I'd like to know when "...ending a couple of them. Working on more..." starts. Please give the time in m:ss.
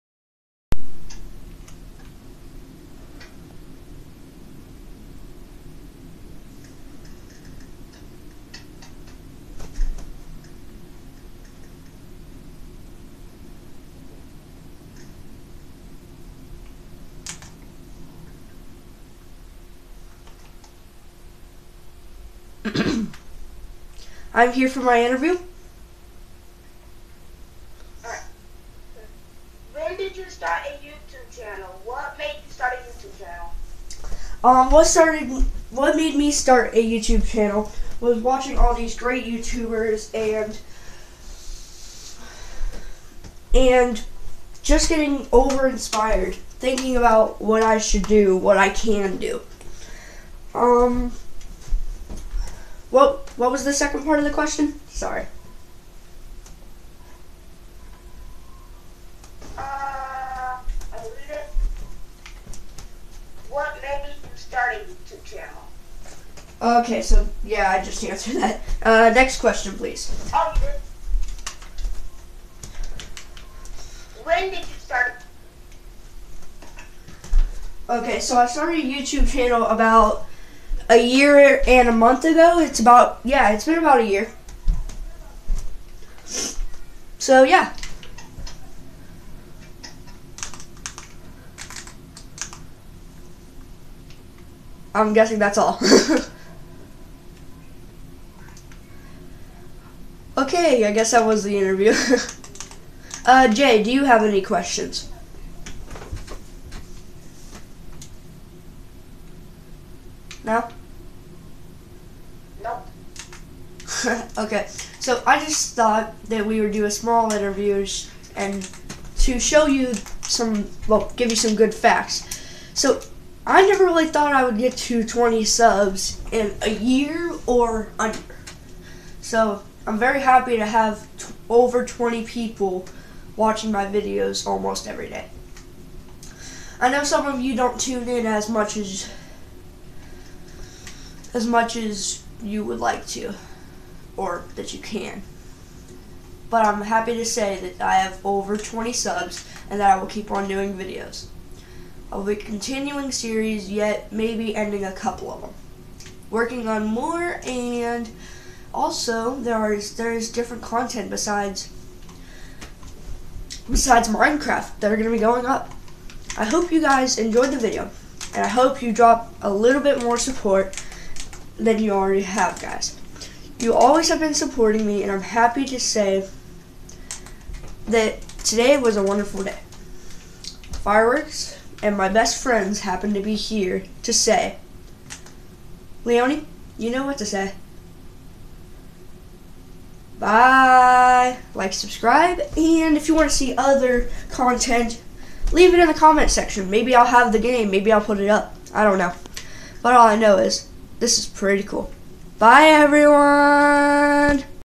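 2:34.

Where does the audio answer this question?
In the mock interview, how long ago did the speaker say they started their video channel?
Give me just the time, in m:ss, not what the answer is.
1:20.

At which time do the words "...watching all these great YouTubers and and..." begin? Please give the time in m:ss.
0:38.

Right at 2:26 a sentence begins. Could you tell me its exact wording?
But I'm happy to say that I have over 20 subs and that I will keep on doing videos.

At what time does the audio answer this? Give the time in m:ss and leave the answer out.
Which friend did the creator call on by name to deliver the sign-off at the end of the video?
3:06.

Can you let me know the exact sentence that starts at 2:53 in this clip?
You always have been supporting me, and I'm happy to say that today was a wonderful day.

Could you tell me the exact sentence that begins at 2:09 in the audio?
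So I'm very happy to have over 20 people watching my videos almost every day.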